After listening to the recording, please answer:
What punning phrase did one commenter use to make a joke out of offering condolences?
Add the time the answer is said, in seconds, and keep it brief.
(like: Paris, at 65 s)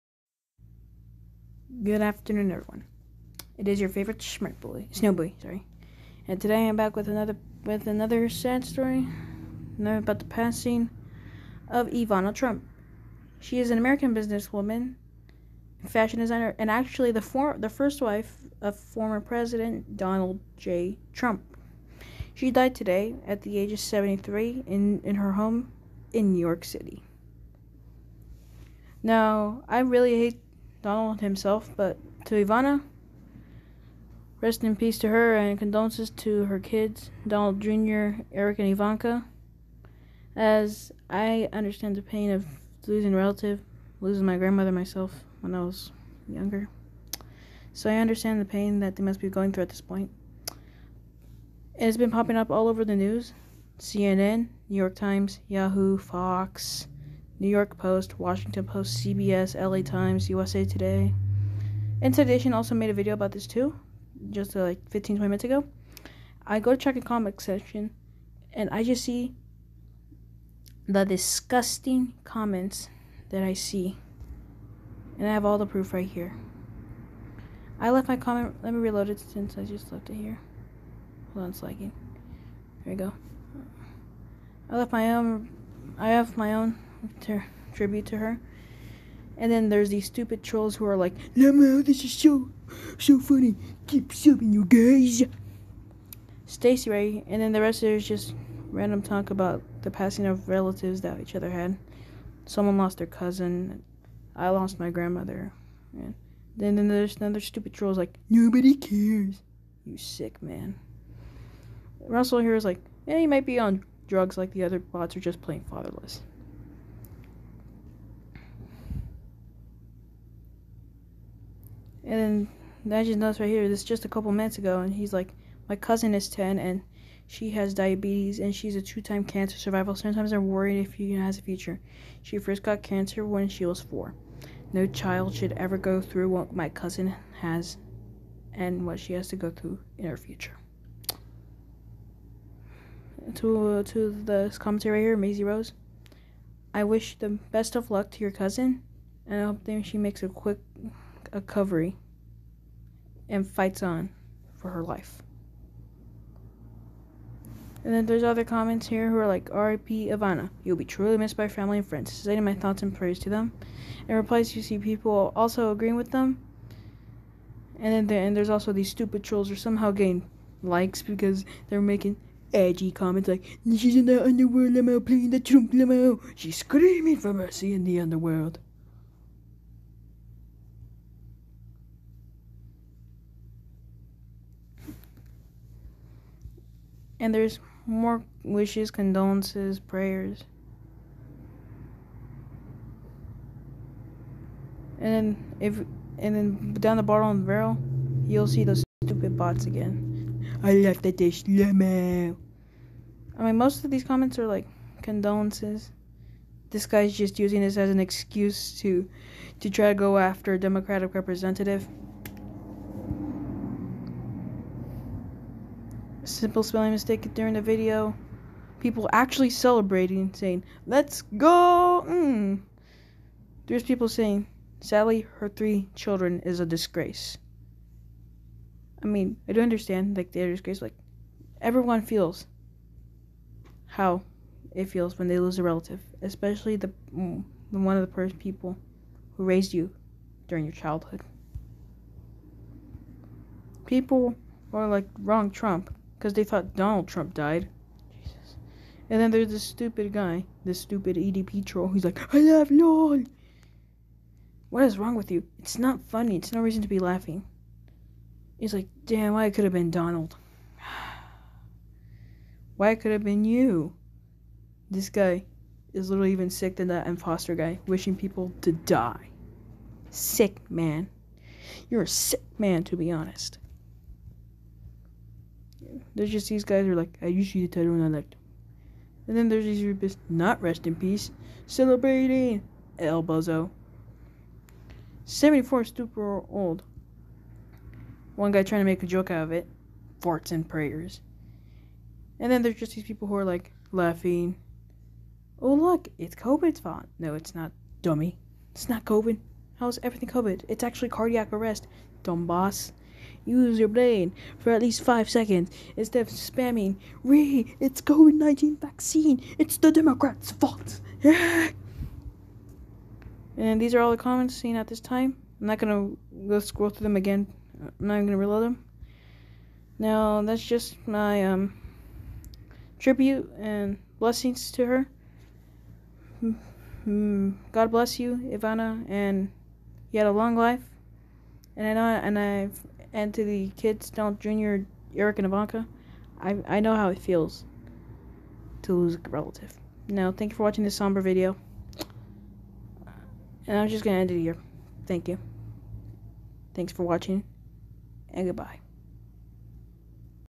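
Farts and prayers, at 290 s.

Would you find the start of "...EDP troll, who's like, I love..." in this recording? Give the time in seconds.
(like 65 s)
251 s.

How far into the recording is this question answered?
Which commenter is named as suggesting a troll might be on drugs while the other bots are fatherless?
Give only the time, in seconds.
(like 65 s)
111 s.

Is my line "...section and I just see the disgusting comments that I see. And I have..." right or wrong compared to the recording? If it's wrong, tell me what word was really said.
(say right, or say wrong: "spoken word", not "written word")
right.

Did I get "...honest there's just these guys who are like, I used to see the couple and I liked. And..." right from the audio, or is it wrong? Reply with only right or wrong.
wrong.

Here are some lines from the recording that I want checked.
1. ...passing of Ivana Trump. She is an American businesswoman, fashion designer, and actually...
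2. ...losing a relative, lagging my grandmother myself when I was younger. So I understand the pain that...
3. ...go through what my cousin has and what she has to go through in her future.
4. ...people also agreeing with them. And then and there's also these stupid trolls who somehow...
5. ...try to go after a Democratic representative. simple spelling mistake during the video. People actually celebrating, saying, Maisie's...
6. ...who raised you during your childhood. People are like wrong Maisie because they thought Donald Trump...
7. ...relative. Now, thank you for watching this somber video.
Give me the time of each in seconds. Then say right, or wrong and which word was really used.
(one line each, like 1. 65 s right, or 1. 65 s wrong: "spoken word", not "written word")
1. 10 s right
2. 42 s wrong: "losing", not "lagging"
3. 135 s right
4. 164 s right
5. 209 s wrong: "Let", not "Maisie"
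6. 239 s wrong: "Trump", not "Maisie"
7. 339 s right.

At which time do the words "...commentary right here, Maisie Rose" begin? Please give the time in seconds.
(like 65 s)
144 s.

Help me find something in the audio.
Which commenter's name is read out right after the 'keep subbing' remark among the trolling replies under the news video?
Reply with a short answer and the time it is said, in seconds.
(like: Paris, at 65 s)
Stacy Ray, at 96 s.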